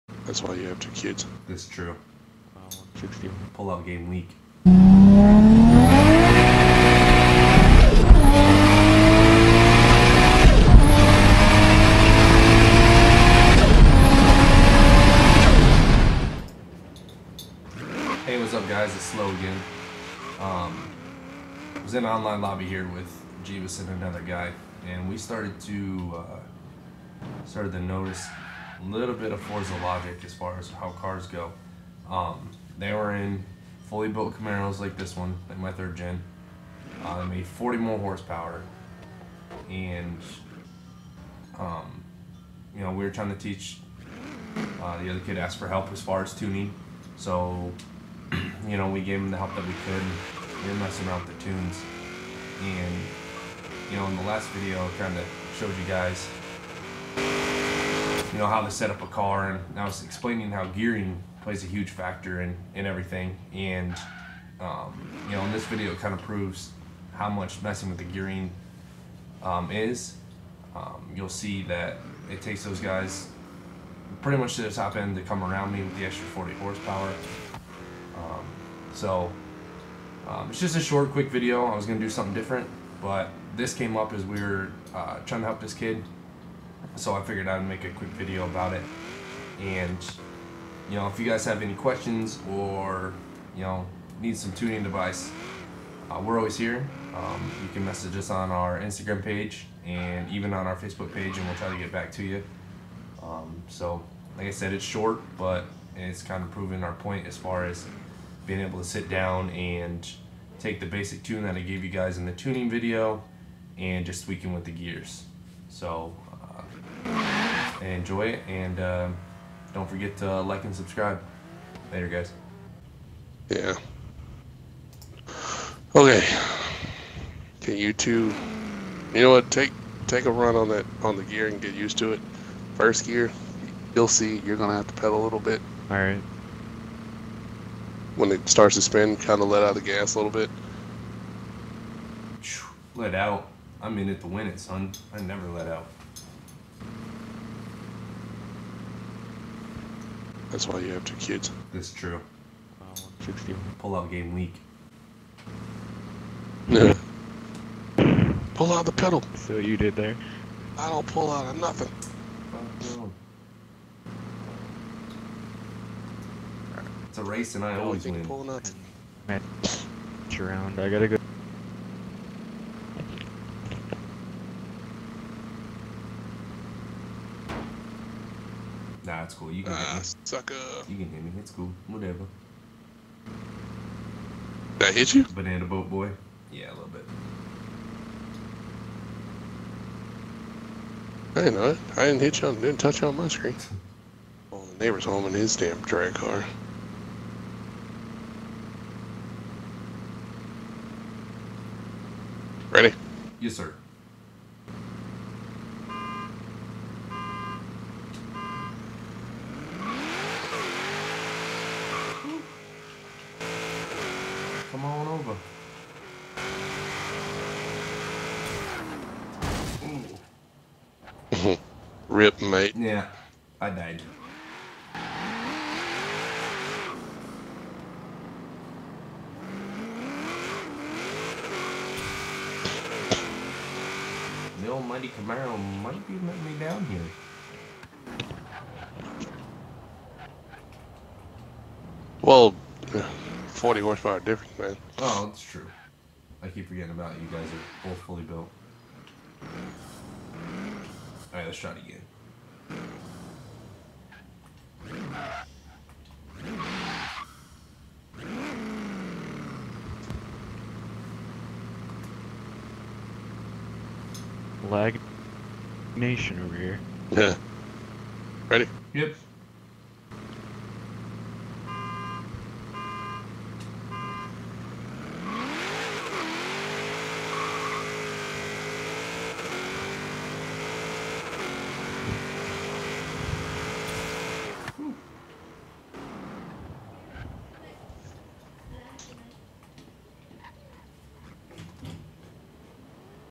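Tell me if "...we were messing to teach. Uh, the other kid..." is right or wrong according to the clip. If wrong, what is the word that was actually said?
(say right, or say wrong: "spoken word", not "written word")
wrong: "trying", not "messing".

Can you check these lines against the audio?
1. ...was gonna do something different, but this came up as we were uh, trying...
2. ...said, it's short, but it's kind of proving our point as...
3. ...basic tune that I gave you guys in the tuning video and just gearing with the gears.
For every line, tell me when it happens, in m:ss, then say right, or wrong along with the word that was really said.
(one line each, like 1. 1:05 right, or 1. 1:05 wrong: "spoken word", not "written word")
1. 1:21 right
2. 1:44 right
3. 1:50 wrong: "tweaking", not "gearing".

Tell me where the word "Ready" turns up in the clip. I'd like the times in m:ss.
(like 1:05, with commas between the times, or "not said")
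3:22, 4:28.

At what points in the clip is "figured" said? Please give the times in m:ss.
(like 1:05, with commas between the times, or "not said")
1:27.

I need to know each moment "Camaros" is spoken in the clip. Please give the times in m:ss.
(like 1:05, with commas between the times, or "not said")
0:34, 3:55.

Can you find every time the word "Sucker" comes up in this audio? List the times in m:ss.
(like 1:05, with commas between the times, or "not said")
3:00.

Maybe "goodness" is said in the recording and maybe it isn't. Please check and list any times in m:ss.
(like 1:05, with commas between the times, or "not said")
not said.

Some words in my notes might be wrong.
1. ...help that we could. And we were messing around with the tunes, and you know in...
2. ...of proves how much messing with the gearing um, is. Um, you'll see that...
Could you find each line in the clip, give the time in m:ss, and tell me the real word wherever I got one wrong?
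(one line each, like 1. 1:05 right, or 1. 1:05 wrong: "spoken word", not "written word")
1. 0:49 right
2. 1:06 right.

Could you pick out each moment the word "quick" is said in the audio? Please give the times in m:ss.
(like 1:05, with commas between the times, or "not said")
1:21, 1:27.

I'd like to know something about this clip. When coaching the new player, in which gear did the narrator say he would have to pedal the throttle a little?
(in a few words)
First gear.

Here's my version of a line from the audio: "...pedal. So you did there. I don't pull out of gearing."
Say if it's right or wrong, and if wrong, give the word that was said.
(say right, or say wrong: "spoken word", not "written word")
wrong: "nothing", not "gearing".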